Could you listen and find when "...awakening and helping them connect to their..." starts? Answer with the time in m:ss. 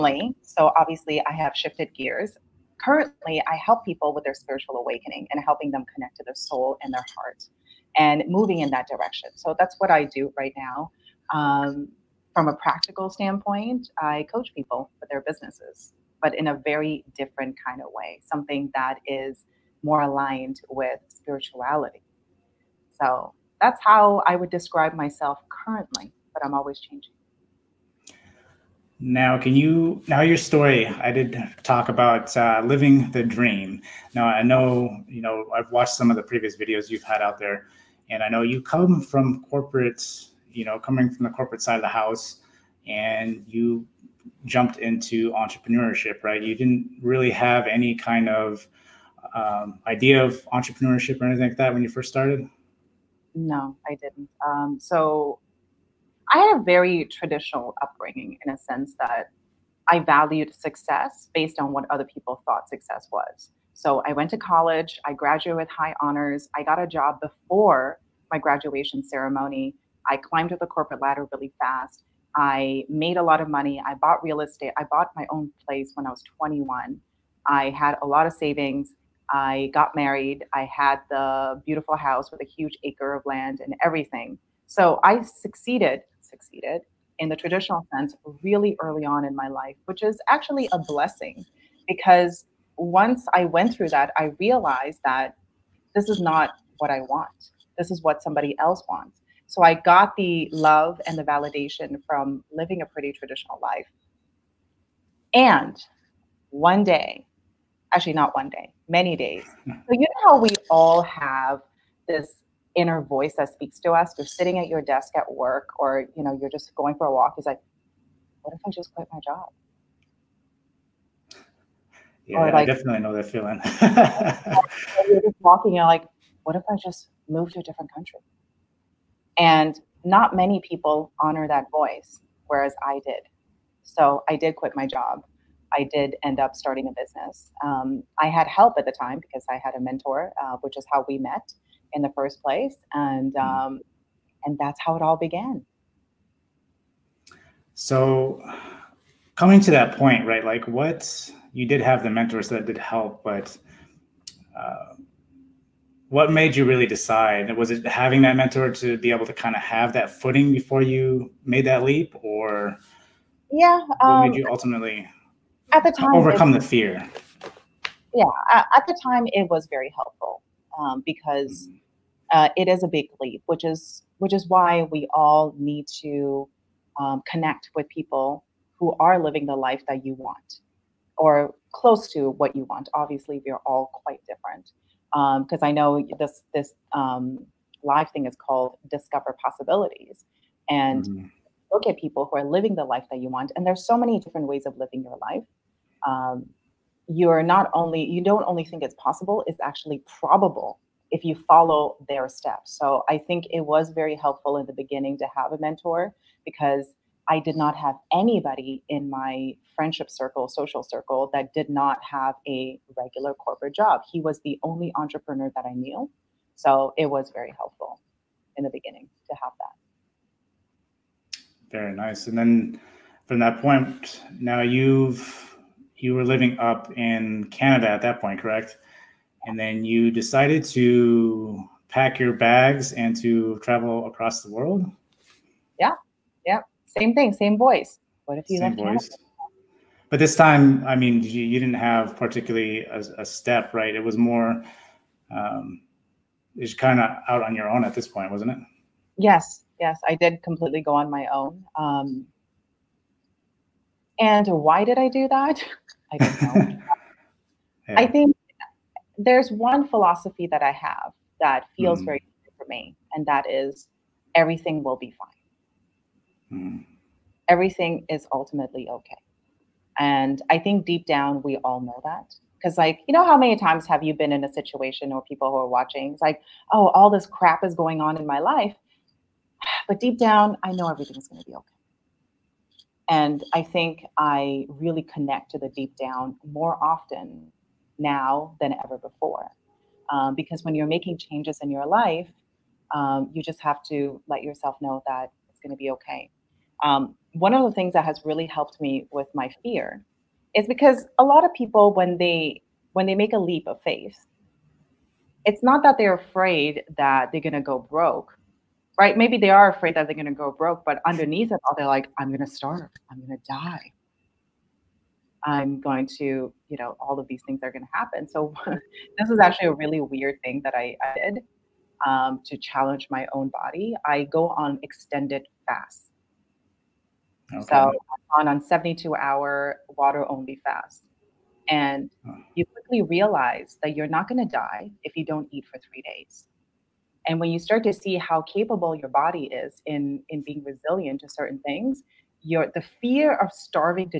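0:04.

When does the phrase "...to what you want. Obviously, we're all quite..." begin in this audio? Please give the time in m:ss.
3:02.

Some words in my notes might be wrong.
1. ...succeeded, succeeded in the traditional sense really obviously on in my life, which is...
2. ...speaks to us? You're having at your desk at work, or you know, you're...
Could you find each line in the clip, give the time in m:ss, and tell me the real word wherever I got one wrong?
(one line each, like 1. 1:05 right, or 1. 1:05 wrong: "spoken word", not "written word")
1. 1:25 wrong: "early", not "obviously"
2. 1:53 wrong: "sitting", not "having".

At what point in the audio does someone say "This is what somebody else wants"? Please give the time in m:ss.
1:37.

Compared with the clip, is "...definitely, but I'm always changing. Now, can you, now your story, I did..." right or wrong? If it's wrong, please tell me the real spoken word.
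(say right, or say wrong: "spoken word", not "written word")
wrong: "currently", not "definitely".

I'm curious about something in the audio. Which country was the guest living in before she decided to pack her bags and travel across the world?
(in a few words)
Canada.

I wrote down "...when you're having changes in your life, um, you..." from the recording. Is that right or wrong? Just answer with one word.
wrong.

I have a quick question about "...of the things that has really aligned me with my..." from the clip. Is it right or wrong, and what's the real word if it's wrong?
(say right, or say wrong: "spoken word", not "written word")
wrong: "helped", not "aligned".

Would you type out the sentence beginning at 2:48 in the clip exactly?
Yeah, at the time it was very helpful um, because mm-hmm.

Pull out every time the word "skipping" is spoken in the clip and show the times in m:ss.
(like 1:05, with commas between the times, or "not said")
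not said.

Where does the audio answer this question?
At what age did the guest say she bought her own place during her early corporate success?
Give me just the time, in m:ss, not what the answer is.
1:16.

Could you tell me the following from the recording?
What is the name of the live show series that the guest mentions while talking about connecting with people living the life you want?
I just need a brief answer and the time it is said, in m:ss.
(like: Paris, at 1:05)
Discover Possibilities, at 3:08.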